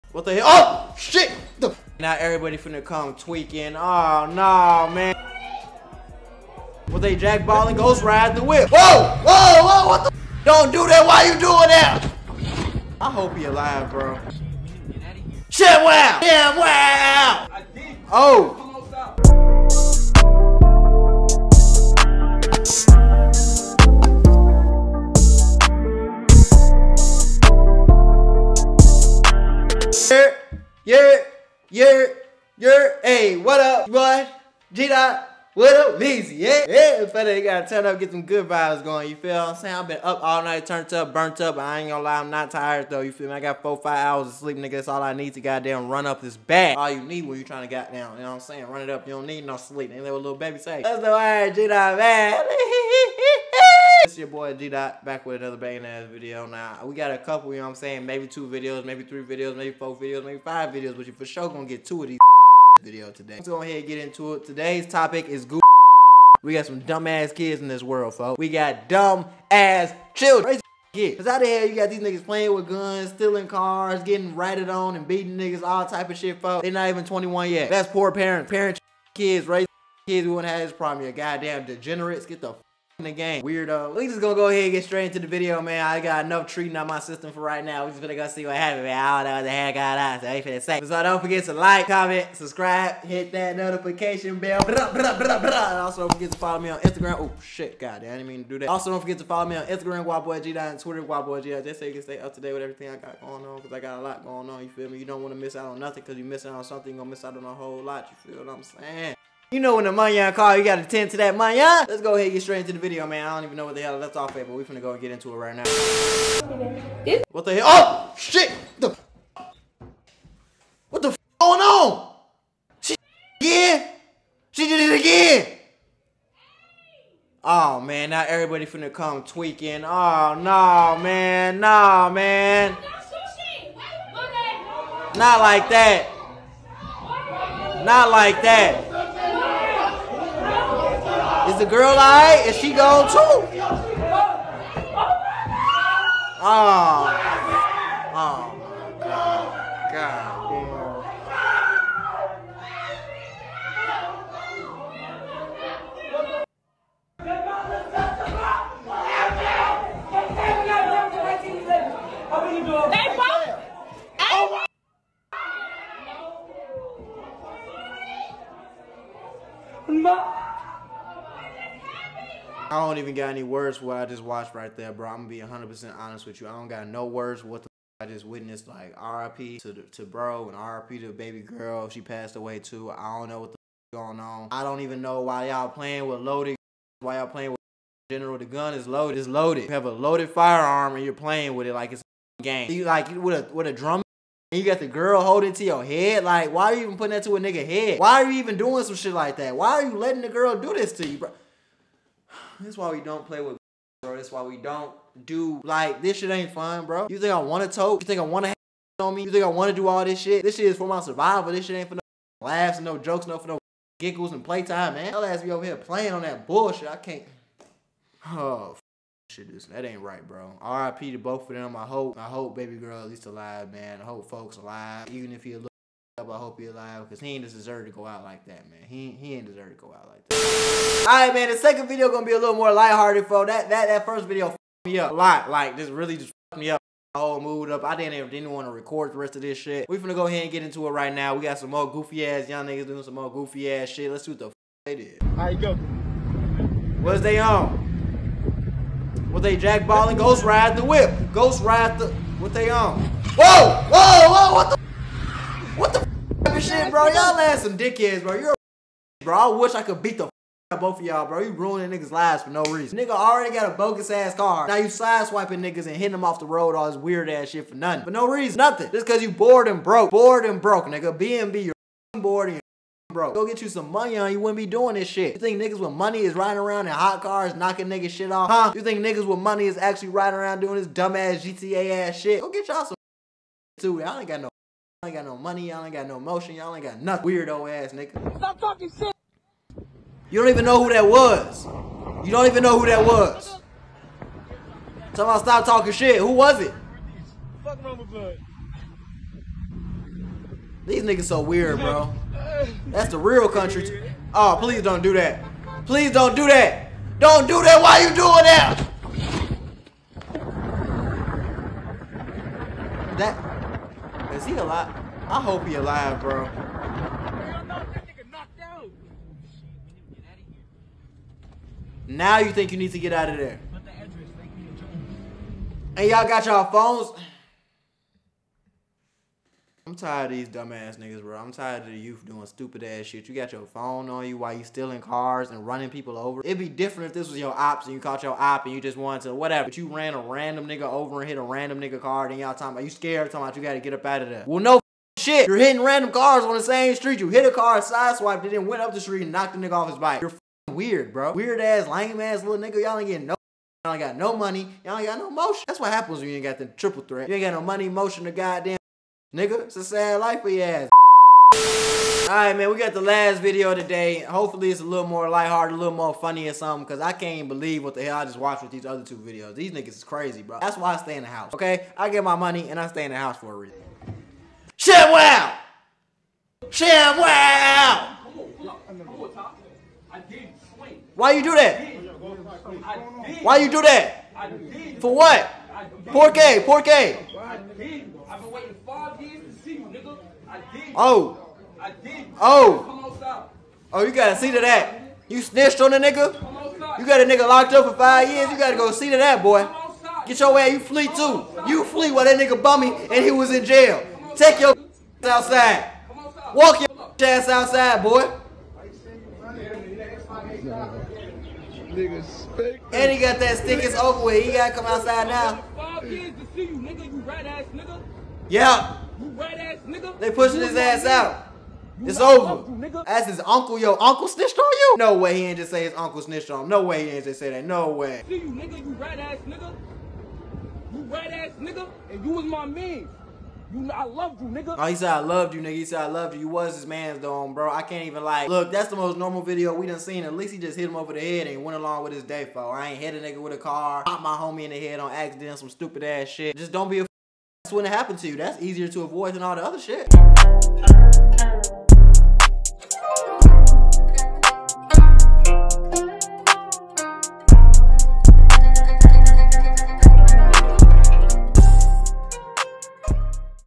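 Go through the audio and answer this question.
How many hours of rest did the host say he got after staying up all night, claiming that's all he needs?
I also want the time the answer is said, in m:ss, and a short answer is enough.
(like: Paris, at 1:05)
4 or 5 hours, at 0:43.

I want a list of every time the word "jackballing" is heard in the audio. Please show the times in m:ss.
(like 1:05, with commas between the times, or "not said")
0:07, 4:09.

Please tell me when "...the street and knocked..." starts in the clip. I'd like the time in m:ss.
5:48.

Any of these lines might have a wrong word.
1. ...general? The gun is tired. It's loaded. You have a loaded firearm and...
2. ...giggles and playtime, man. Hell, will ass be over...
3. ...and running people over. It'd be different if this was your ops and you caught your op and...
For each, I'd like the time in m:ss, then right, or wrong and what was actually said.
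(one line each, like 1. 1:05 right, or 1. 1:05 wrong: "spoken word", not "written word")
1. 3:08 wrong: "loaded", not "tired"
2. 3:33 right
3. 5:35 right.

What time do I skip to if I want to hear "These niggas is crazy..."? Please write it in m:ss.
6:09.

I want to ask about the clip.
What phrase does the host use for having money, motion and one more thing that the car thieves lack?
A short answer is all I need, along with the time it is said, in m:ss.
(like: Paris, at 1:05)
triple threat, at 5:56.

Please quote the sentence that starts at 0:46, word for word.
All you need when you trying to get down, you know what I'm saying?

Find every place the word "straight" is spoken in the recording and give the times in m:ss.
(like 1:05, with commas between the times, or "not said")
1:24, 1:52.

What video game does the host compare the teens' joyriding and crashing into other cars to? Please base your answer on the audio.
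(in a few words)
GTA.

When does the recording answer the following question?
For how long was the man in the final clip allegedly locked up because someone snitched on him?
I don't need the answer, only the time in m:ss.
6:37.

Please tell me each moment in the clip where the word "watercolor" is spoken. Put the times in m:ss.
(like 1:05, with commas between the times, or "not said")
not said.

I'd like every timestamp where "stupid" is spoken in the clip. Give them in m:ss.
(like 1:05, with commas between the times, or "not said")
5:32, 7:25.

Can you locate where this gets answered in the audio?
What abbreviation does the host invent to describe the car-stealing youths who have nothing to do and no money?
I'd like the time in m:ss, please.
4:31.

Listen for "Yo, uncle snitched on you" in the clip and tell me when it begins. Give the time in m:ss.
7:03.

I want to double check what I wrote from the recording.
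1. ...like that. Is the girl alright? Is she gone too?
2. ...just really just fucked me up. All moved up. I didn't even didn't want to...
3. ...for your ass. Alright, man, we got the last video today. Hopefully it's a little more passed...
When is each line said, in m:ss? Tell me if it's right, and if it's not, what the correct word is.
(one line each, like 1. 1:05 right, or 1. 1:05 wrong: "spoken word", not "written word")
1. 2:18 right
2. 3:55 right
3. 6:00 wrong: "lighthearted", not "passed".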